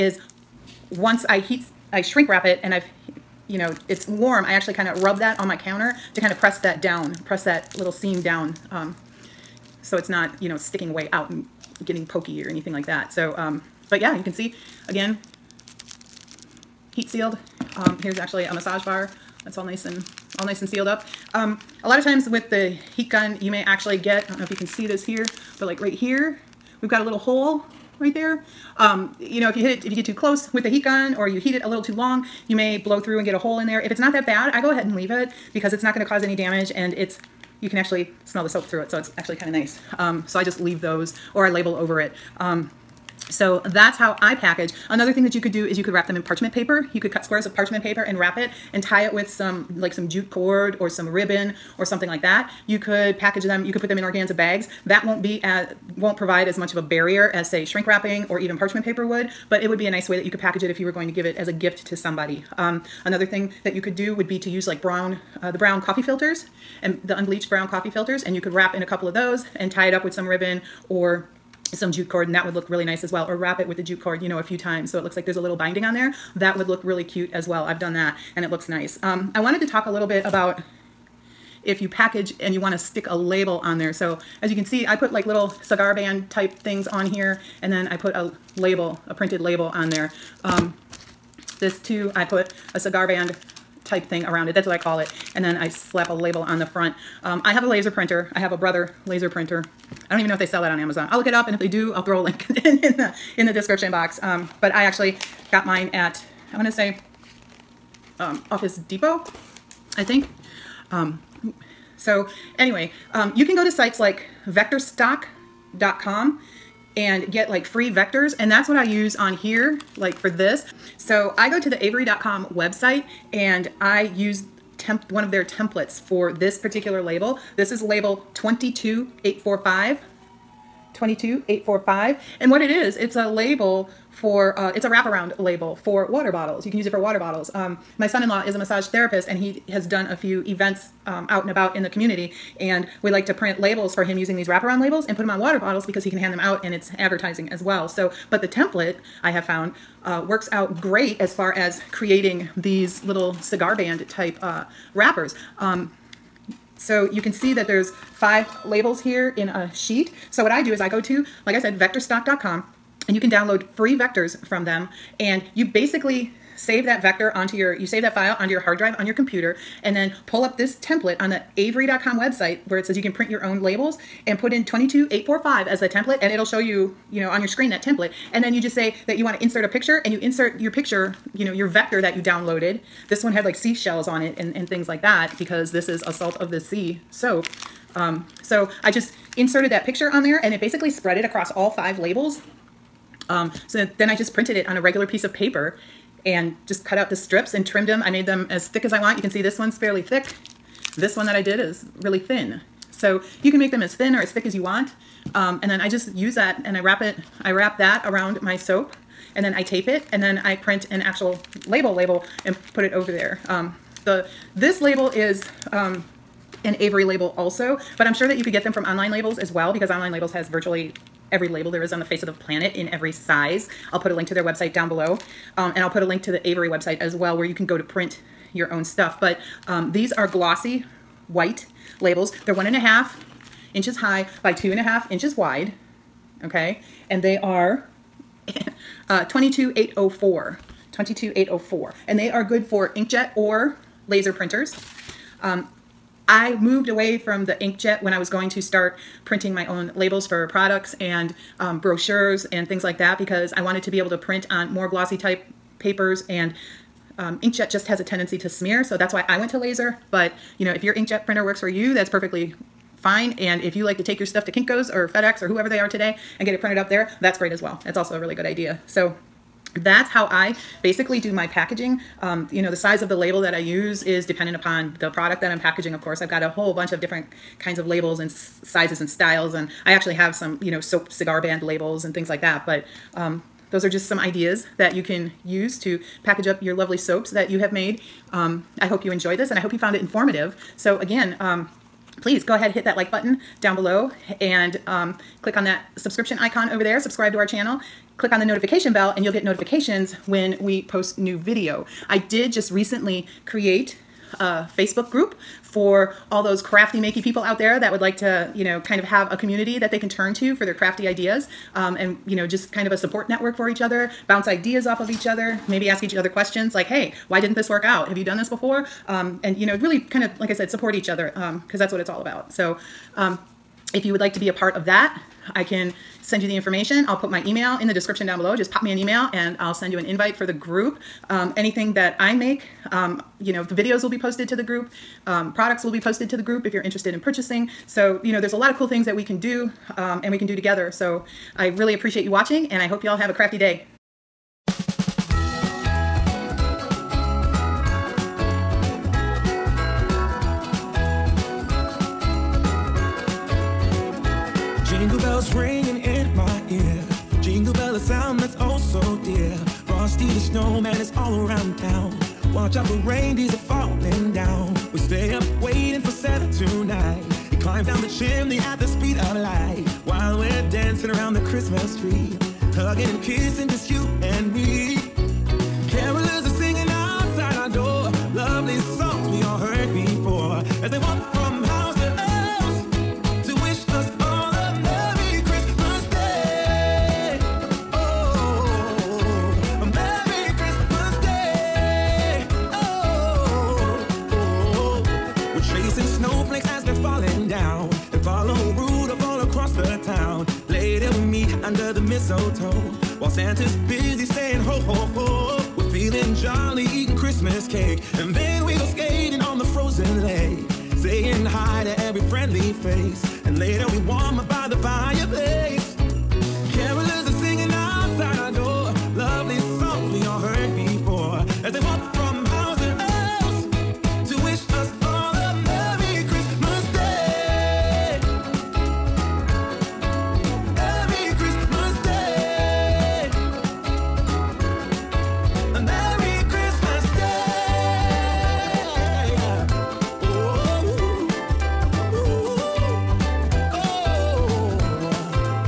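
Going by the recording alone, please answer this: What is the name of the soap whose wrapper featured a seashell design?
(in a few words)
salt of the sea.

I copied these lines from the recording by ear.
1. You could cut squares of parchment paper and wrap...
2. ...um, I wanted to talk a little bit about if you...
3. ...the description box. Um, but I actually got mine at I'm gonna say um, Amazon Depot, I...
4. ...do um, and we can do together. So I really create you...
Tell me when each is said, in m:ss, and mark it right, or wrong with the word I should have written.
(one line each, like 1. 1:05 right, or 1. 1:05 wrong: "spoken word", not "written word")
1. 0:46 right
2. 1:19 right
3. 1:43 wrong: "Office", not "Amazon"
4. 5:39 wrong: "appreciate", not "create".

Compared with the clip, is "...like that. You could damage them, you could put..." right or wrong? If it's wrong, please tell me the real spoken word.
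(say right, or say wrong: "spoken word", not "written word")
wrong: "package", not "damage".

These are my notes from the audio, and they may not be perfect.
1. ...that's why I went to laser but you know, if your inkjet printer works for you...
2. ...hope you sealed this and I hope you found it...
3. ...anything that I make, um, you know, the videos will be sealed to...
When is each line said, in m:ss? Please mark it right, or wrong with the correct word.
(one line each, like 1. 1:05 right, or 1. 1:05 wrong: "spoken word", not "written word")
1. 4:18 right
2. 4:48 wrong: "enjoyed", not "sealed"
3. 5:31 wrong: "posted", not "sealed".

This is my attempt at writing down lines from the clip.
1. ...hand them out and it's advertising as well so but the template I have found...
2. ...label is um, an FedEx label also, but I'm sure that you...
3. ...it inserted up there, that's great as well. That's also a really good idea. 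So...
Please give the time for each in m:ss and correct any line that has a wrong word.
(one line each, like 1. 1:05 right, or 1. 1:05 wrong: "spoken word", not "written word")
1. 2:26 right
2. 3:34 wrong: "Avery", not "FedEx"
3. 4:26 wrong: "printed", not "inserted".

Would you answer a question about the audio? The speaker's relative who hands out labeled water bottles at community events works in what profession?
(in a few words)
massage therapist.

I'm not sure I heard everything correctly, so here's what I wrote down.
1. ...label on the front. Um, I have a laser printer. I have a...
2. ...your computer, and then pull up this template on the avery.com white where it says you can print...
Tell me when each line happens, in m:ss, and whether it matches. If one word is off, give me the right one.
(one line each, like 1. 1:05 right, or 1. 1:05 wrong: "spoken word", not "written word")
1. 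1:36 right
2. 2:49 wrong: "website", not "white".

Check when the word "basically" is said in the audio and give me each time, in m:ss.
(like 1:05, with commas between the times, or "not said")
2:45, 3:10, 4:30.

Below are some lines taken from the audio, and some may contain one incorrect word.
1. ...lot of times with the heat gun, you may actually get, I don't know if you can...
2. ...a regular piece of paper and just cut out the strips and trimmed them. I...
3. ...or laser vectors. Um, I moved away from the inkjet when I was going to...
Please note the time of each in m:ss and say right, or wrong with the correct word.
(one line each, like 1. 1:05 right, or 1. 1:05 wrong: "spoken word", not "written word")
1. 0:21 right
2. 3:14 right
3. 4:03 wrong: "printers", not "vectors".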